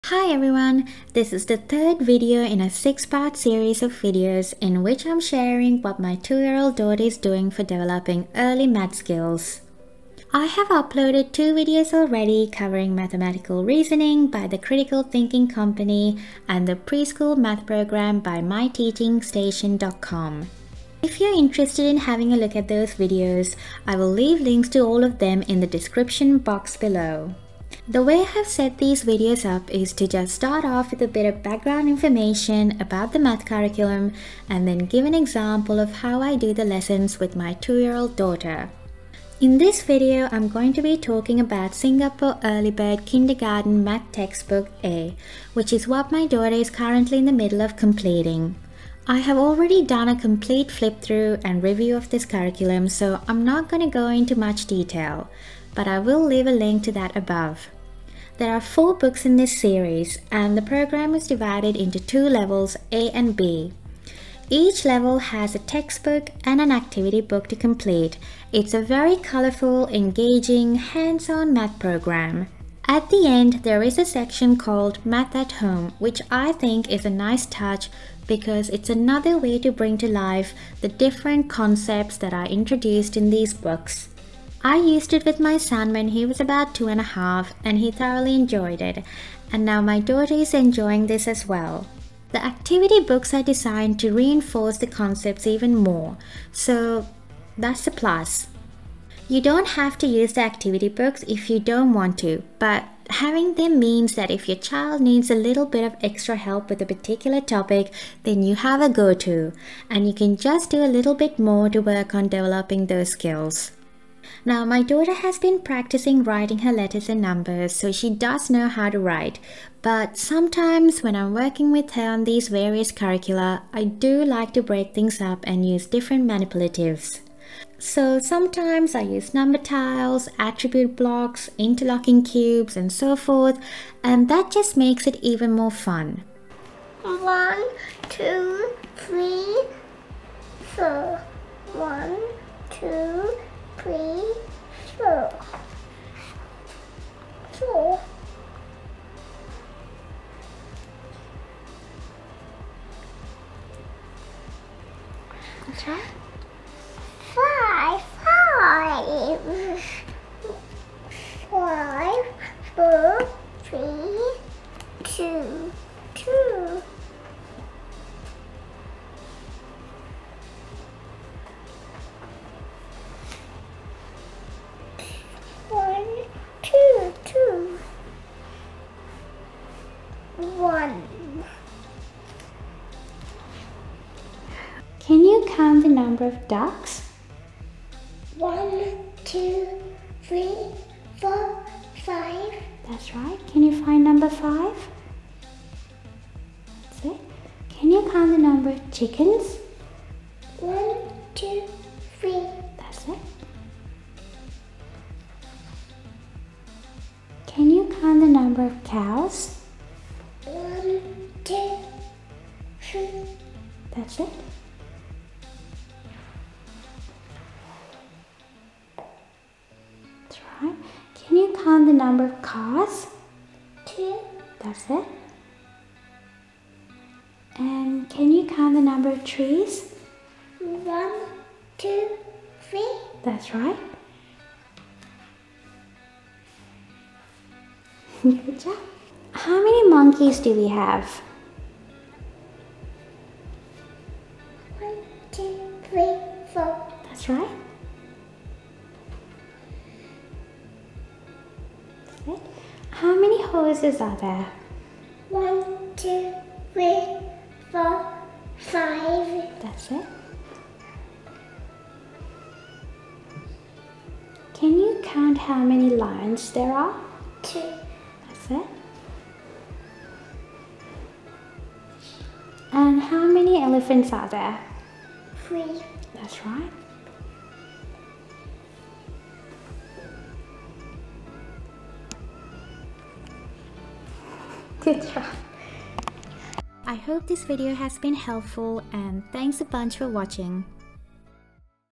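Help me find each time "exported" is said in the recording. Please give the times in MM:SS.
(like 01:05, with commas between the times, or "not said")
not said.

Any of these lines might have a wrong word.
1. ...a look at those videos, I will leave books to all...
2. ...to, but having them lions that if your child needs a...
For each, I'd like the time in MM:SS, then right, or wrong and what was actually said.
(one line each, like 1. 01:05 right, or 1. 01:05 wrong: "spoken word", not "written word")
1. 00:22 wrong: "links", not "books"
2. 01:42 wrong: "means", not "lions".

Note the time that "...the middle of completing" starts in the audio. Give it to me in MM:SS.
00:47.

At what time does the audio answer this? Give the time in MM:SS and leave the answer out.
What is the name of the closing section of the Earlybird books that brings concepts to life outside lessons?
01:15.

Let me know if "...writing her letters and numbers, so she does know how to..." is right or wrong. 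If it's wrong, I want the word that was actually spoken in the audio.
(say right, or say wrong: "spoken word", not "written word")
right.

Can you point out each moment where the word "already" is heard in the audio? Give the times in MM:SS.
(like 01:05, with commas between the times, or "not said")
00:11, 00:49.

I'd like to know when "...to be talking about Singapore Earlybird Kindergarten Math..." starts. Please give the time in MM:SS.
00:40.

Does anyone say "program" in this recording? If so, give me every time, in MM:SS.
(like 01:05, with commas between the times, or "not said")
00:17, 01:00, 01:11.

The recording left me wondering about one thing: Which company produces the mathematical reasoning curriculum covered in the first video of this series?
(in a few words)
the Critical Thinking Company.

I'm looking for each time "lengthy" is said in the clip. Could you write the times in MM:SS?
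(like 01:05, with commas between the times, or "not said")
not said.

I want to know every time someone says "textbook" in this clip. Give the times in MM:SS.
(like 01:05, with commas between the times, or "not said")
00:44, 01:05.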